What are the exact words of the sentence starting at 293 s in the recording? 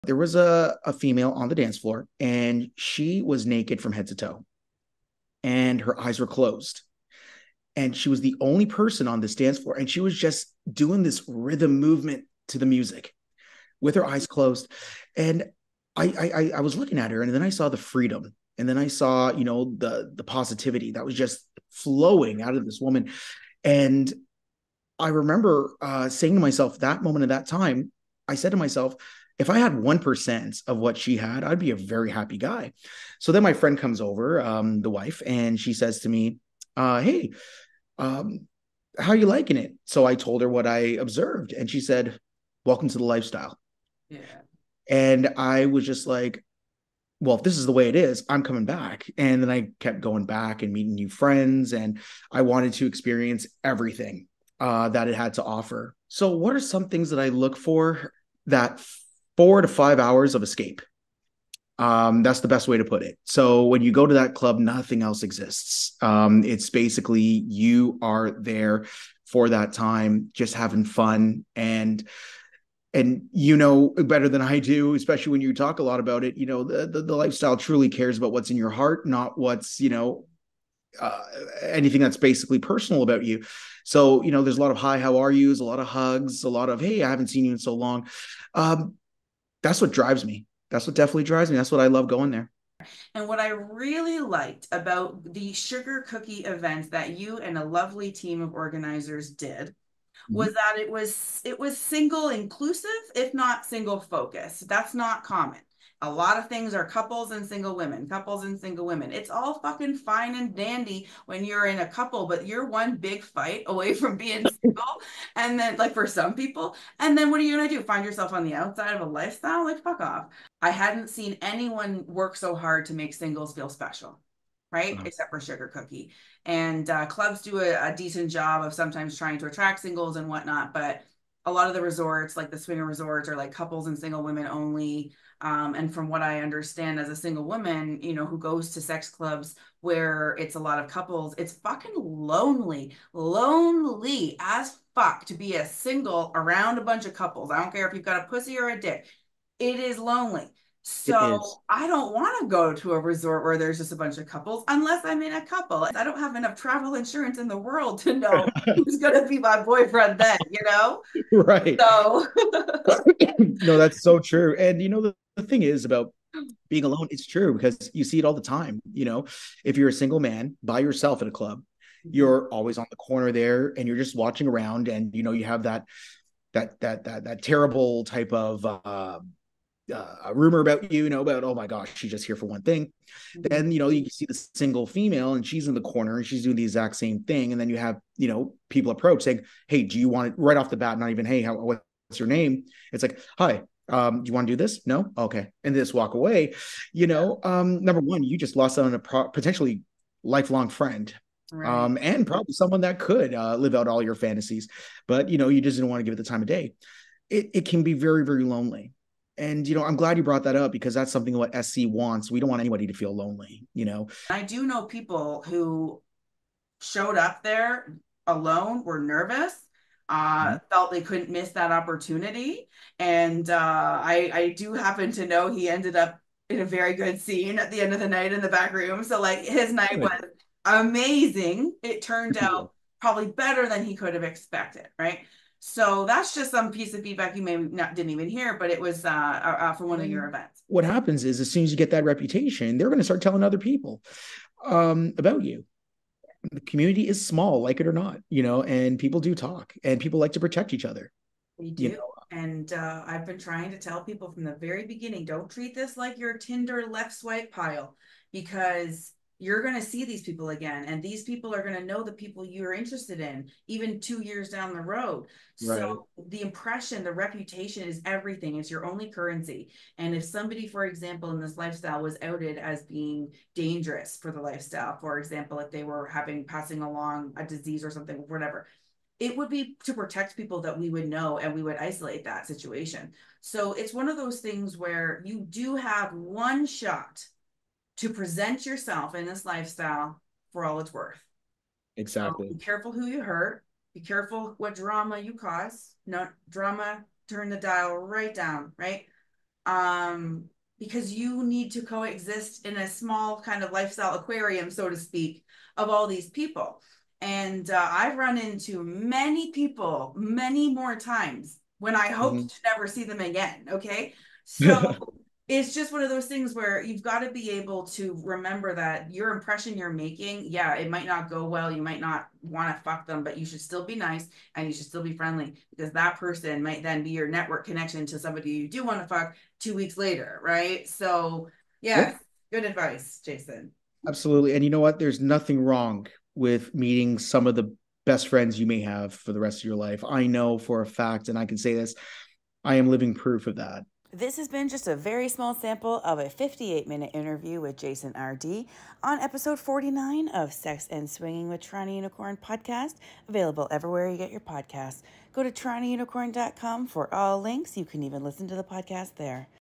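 Be careful what drama you cause.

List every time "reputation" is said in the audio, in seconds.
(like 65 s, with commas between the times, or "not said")
242 s, 267 s.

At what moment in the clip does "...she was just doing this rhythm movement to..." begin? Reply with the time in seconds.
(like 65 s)
9 s.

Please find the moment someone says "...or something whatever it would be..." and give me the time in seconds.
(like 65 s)
277 s.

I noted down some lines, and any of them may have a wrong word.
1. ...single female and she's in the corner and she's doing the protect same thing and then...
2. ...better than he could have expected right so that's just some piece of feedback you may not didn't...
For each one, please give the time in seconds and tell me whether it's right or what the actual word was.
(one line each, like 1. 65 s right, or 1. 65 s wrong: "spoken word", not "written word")
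1. 184 s wrong: "exact", not "protect"
2. 233 s right.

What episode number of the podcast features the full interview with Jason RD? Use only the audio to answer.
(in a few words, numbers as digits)
49.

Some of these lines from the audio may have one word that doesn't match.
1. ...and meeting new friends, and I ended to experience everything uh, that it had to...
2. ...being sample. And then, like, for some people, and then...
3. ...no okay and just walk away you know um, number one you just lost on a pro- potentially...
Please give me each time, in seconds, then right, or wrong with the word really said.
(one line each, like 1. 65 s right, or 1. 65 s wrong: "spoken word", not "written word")
1. 50 s wrong: "wanted", not "ended"
2. 114 s wrong: "single", not "sample"
3. 194 s right.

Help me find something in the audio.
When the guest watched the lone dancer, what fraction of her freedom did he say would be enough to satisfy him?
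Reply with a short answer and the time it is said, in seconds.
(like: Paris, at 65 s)
1%, at 29 s.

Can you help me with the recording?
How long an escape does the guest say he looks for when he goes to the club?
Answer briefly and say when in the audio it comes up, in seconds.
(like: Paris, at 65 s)
four to five hours, at 59 s.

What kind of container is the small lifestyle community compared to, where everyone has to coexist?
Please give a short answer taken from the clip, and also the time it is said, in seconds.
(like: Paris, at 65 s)
aquarium, at 304 s.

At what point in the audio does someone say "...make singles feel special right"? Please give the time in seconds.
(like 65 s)
122 s.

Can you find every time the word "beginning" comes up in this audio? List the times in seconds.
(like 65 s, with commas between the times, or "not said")
254 s.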